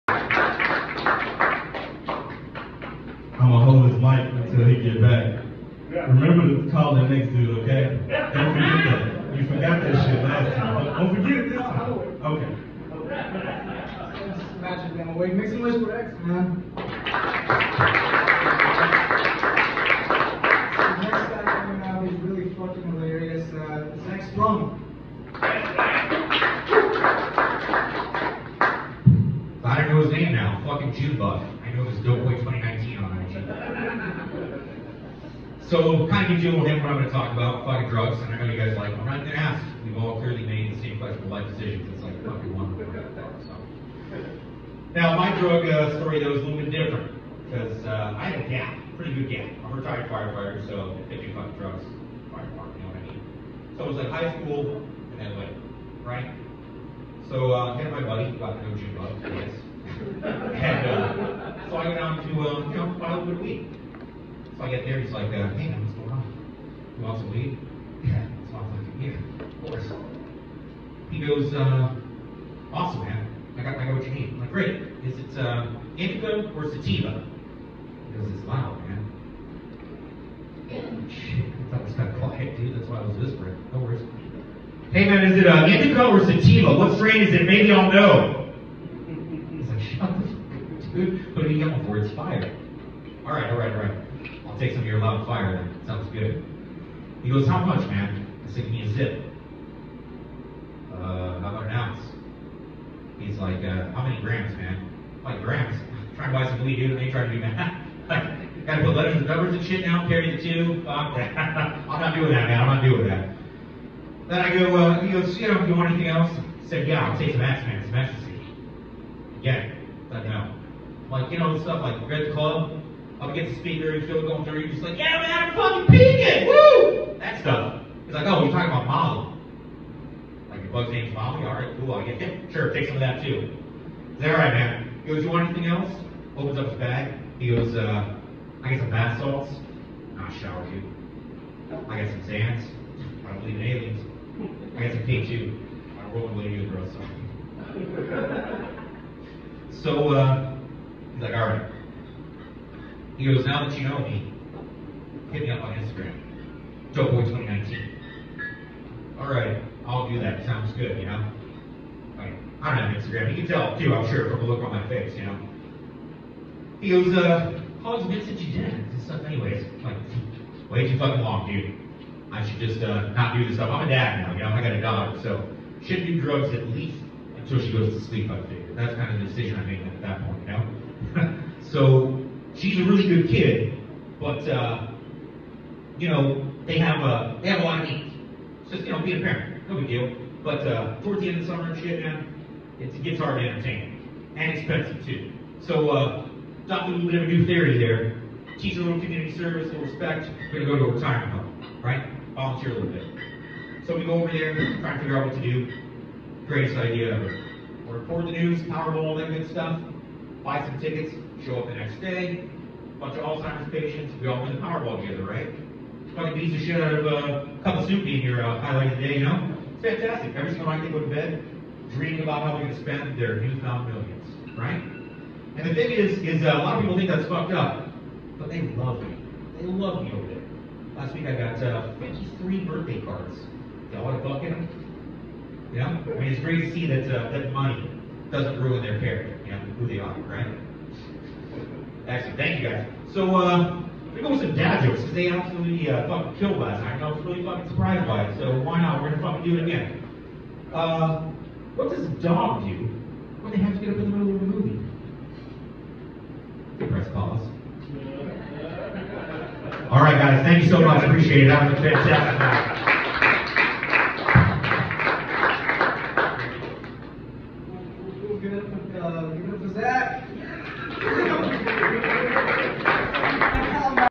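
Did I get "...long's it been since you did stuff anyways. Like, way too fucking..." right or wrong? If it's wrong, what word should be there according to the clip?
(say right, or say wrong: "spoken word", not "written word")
right.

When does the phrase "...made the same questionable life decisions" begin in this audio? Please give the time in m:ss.
0:40.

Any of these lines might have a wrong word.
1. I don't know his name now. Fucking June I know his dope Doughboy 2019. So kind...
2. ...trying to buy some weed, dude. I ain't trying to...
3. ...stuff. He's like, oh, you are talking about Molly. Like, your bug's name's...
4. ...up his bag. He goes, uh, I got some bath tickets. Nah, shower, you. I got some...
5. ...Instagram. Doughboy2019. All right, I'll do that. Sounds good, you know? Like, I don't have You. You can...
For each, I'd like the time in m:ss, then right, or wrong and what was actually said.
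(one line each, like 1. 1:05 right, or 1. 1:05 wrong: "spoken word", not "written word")
1. 0:25 right
2. 1:46 right
3. 2:07 right
4. 2:16 wrong: "salts", not "tickets"
5. 2:35 wrong: "Instagram", not "You".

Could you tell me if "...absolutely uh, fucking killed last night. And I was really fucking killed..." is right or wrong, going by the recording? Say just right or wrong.
wrong.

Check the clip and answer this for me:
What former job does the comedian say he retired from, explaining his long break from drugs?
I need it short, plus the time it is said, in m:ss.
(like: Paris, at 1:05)
Firefighter, at 0:49.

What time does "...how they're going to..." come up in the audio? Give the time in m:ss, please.
3:42.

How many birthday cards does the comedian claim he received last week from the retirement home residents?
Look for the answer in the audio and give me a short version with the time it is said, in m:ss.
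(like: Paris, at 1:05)
53, at 3:51.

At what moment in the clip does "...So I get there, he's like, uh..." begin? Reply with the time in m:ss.
1:04.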